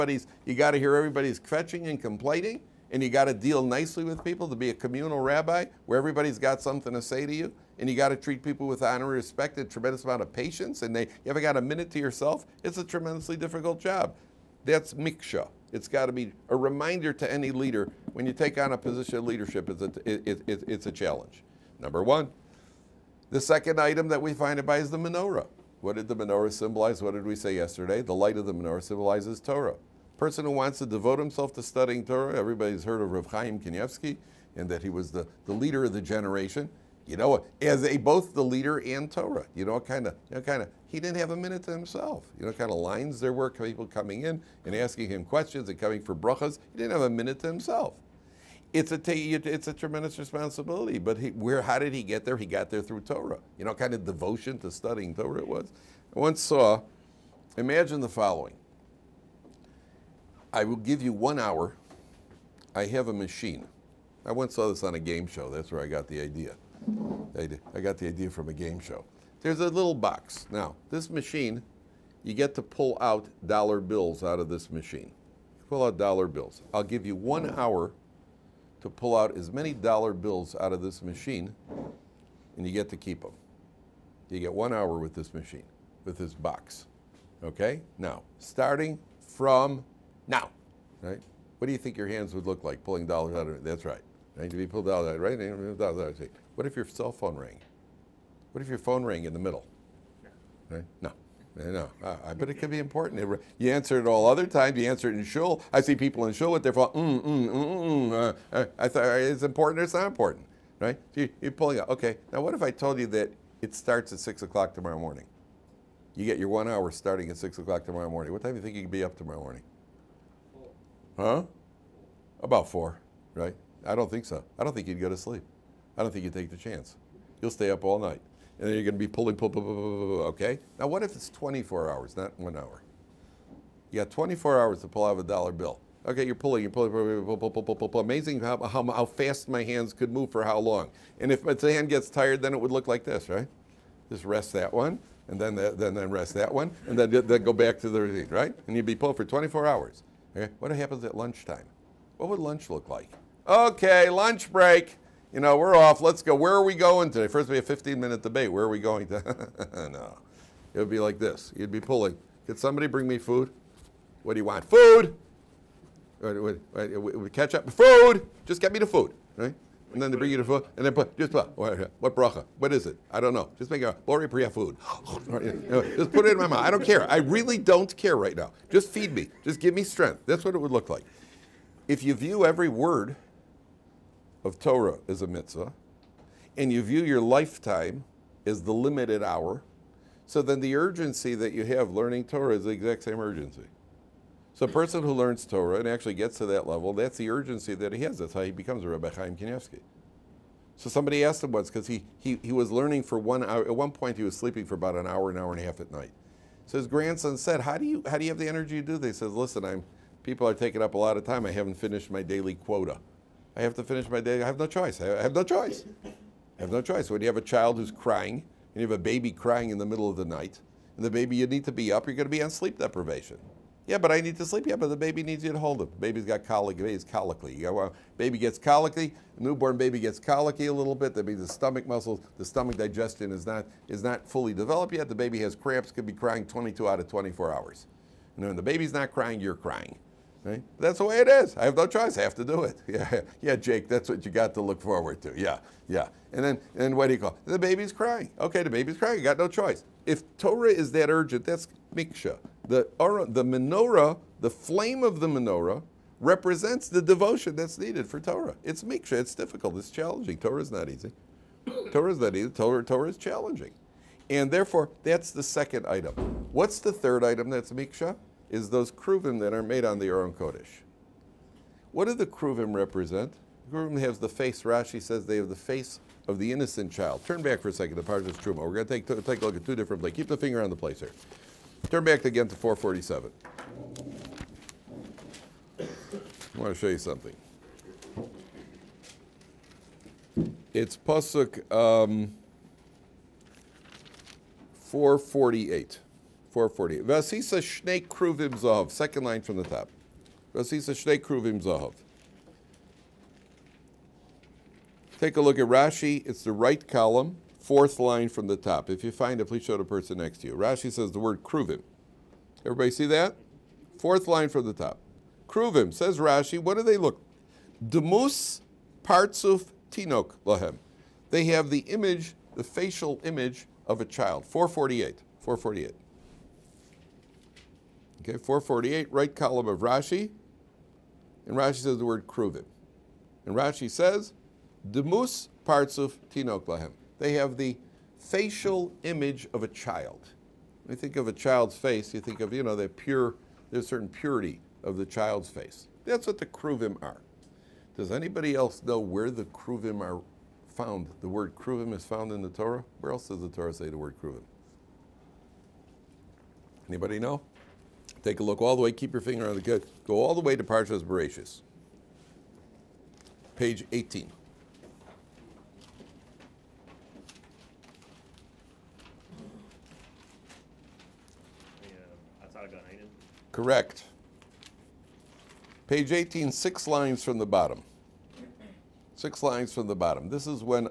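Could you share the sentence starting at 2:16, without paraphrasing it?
Okay, you're pulling, you're pulling, pull, pull, pull, pull, pull, pull.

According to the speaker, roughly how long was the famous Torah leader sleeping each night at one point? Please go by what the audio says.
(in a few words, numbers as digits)
an hour and a half.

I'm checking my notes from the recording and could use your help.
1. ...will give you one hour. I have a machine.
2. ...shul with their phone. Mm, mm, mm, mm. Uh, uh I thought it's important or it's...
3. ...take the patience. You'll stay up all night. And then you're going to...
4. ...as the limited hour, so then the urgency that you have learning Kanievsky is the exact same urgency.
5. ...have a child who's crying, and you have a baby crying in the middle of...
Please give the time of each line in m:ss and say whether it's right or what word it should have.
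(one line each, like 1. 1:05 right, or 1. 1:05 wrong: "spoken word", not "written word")
1. 1:00 right
2. 1:46 right
3. 2:06 wrong: "chance", not "patience"
4. 3:08 wrong: "Torah", not "Kanievsky"
5. 3:37 right.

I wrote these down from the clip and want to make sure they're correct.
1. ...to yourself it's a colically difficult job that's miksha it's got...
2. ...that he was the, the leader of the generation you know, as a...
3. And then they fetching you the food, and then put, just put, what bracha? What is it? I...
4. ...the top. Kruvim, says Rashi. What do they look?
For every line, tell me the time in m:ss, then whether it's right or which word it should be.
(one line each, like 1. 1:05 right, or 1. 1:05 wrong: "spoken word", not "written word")
1. 0:11 wrong: "tremendously", not "colically"
2. 0:34 right
3. 2:49 wrong: "bring", not "fetching"
4. 5:14 right.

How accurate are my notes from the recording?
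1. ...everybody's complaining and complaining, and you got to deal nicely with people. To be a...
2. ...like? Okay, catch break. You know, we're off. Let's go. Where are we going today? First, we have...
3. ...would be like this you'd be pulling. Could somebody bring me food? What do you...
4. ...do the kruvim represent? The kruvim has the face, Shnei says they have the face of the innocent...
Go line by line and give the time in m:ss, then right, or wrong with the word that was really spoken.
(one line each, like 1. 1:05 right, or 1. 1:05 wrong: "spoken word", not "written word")
1. 0:00 wrong: "fetching", not "complaining"
2. 2:32 wrong: "lunch", not "catch"
3. 2:40 right
4. 4:32 wrong: "Rashi", not "Shnei".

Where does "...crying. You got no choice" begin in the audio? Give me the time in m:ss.
4:08.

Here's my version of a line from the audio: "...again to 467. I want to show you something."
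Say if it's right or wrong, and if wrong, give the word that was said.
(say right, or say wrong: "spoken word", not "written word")
wrong: "447", not "467".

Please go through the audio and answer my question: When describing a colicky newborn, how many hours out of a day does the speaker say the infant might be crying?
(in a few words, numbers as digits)
22.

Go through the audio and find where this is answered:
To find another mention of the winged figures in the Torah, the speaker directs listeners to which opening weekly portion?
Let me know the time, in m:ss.
6:00.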